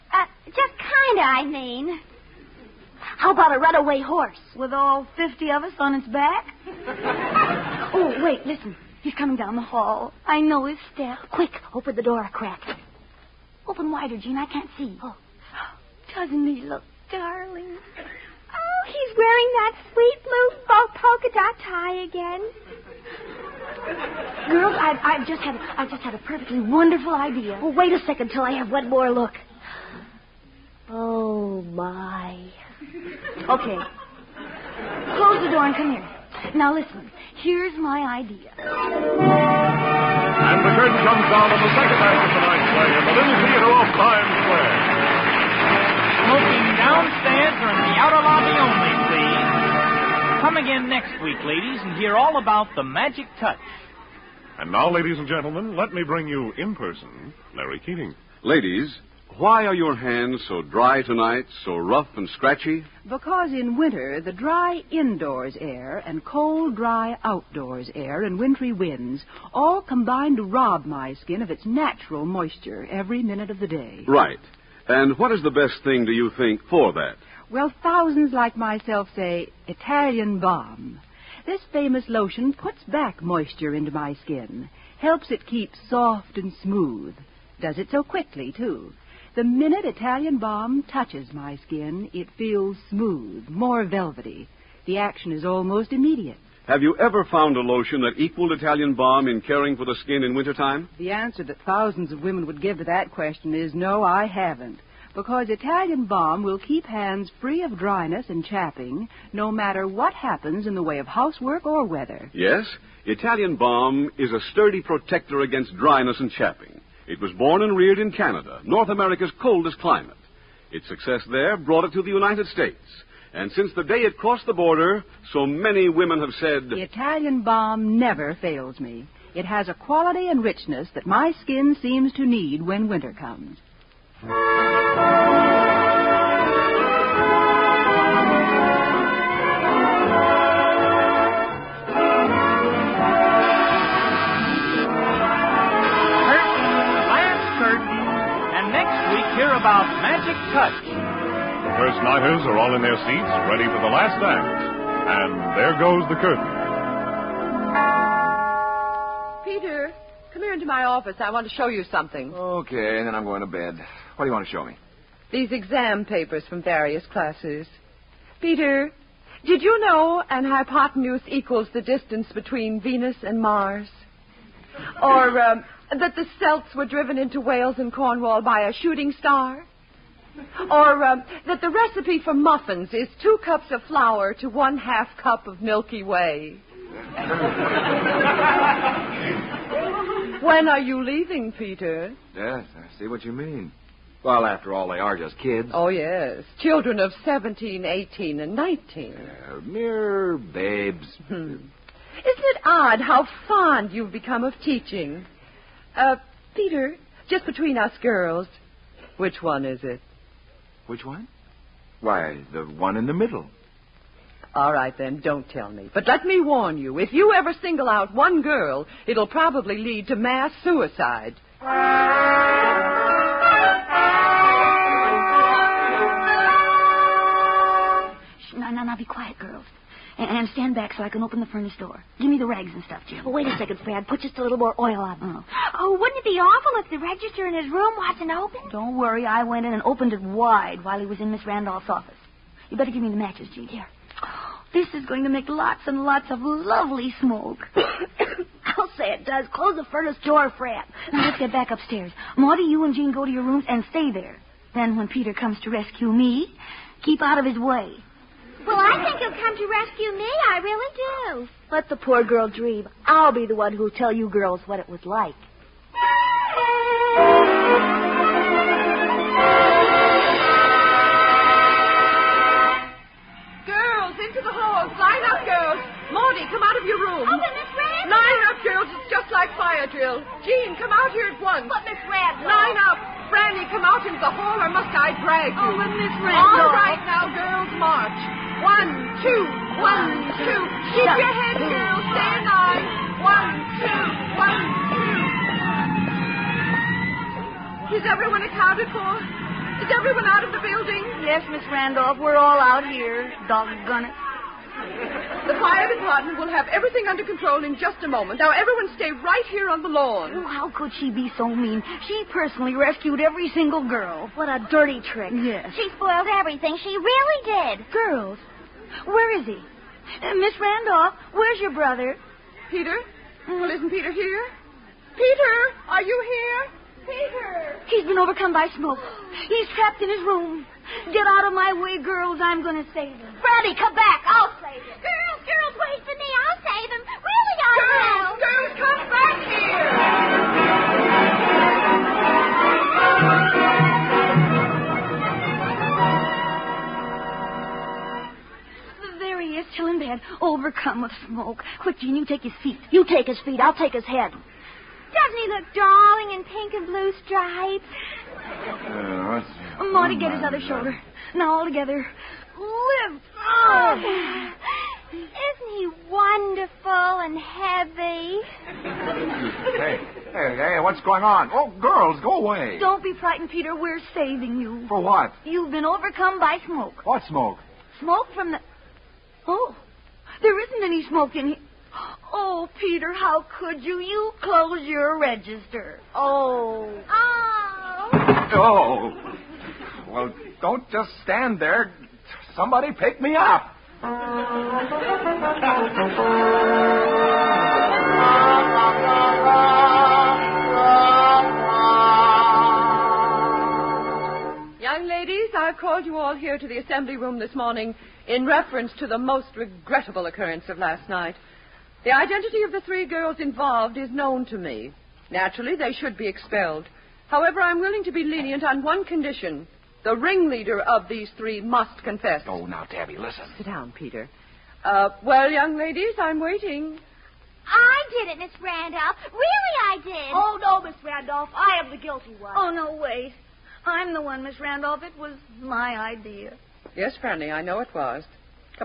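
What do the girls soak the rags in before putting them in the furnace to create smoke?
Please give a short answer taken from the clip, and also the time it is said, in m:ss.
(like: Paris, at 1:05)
oil, at 3:54.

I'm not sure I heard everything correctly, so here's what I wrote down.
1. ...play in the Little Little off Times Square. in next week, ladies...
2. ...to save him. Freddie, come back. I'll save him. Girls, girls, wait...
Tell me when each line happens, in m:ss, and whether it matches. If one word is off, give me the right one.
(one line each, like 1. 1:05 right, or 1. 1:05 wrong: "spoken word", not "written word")
1. 0:42 wrong: "Theater", not "Little"
2. 5:32 right.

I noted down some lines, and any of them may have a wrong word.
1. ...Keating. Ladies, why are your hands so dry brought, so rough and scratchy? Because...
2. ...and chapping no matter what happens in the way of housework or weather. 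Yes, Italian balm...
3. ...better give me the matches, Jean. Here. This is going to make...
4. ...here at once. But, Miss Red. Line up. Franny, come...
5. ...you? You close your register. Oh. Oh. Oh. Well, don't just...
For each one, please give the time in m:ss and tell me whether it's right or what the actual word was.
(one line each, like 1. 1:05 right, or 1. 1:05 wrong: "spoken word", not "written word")
1. 0:57 wrong: "tonight", not "brought"
2. 1:48 right
3. 4:02 right
4. 4:41 right
5. 6:23 right.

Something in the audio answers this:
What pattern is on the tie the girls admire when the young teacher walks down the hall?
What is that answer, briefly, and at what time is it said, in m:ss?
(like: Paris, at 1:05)
blue polka dot, at 0:20.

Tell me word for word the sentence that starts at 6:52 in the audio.
The identity of the three girls involved is known to me.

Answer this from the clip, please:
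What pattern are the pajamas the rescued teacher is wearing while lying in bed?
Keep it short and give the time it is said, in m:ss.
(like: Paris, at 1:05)
pink and blue stripes, at 5:56.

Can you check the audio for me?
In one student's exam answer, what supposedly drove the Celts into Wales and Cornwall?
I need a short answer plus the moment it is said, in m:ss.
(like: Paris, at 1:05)
a shooting star, at 2:58.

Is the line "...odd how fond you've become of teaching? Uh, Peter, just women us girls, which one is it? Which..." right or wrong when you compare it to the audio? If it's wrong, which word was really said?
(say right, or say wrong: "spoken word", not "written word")
wrong: "between", not "women".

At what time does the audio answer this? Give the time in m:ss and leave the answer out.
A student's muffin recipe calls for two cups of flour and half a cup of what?
3:05.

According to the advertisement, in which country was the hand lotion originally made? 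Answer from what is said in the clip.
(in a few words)
Canada.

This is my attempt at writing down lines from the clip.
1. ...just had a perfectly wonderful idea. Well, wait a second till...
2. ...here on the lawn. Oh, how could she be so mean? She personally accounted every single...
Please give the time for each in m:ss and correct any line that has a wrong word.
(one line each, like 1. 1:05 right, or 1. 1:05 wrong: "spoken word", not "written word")
1. 0:25 right
2. 5:09 wrong: "rescued", not "accounted".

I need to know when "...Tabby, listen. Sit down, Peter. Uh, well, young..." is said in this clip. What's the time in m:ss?
7:02.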